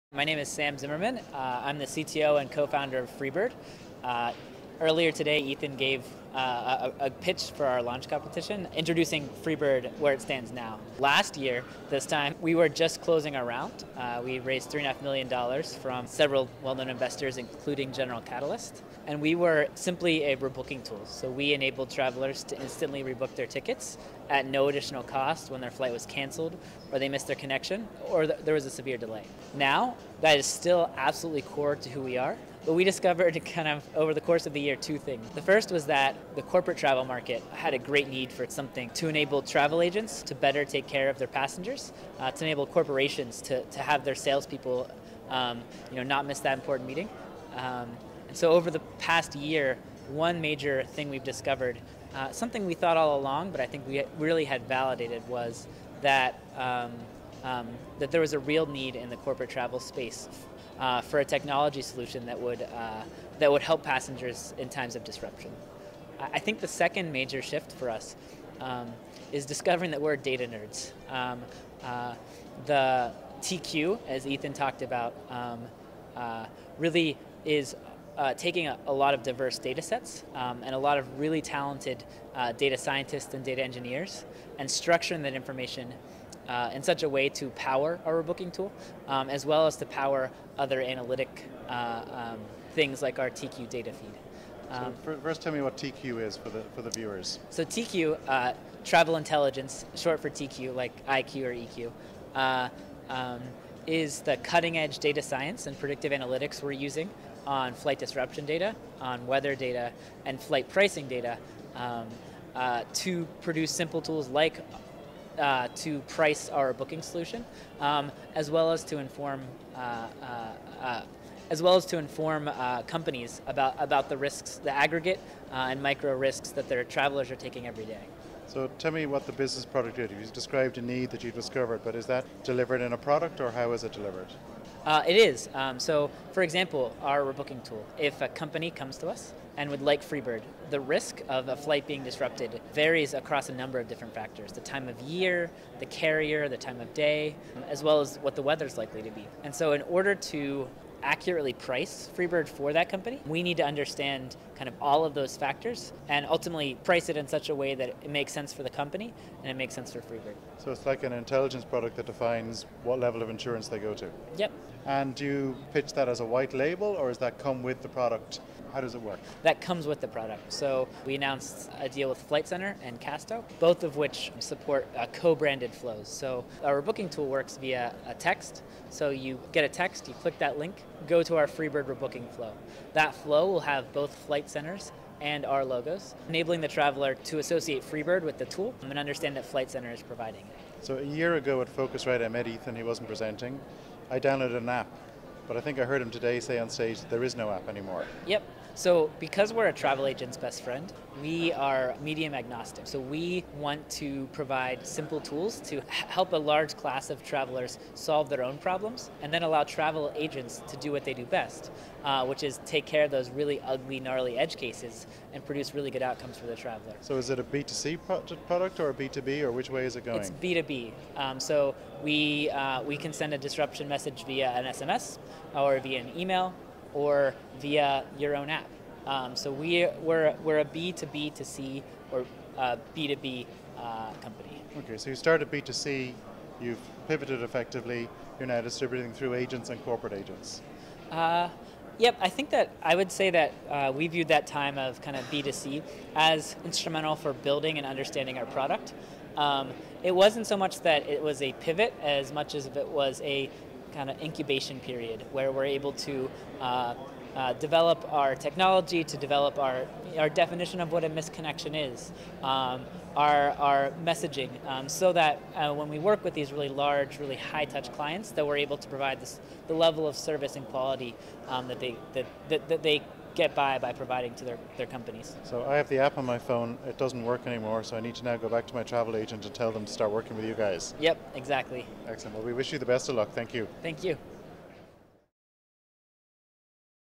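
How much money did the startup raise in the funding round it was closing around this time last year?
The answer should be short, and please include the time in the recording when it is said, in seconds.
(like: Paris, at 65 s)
$3.5 million, at 14 s.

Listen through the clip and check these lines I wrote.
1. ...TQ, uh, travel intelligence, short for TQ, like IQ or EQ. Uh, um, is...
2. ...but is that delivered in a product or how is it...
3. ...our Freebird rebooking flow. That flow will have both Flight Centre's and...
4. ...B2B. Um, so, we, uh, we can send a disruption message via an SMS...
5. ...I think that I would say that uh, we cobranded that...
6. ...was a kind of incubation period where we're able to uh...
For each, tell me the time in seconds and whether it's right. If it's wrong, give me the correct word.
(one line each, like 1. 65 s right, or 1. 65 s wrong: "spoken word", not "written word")
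1. 97 s right
2. 131 s right
3. 181 s right
4. 220 s right
5. 242 s wrong: "viewed", not "cobranded"
6. 252 s right.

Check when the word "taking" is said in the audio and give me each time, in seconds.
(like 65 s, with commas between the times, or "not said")
78 s, 127 s.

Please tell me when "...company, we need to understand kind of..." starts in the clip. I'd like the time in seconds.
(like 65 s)
152 s.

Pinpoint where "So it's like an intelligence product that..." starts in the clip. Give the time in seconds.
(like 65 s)
160 s.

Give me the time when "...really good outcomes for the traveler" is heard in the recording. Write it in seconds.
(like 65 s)
215 s.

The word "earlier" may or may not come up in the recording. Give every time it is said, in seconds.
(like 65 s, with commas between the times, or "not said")
4 s.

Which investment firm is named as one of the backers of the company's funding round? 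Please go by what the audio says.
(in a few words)
General Catalyst.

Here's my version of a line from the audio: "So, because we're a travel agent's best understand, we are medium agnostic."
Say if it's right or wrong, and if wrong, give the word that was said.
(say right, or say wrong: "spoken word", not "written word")
wrong: "friend", not "understand".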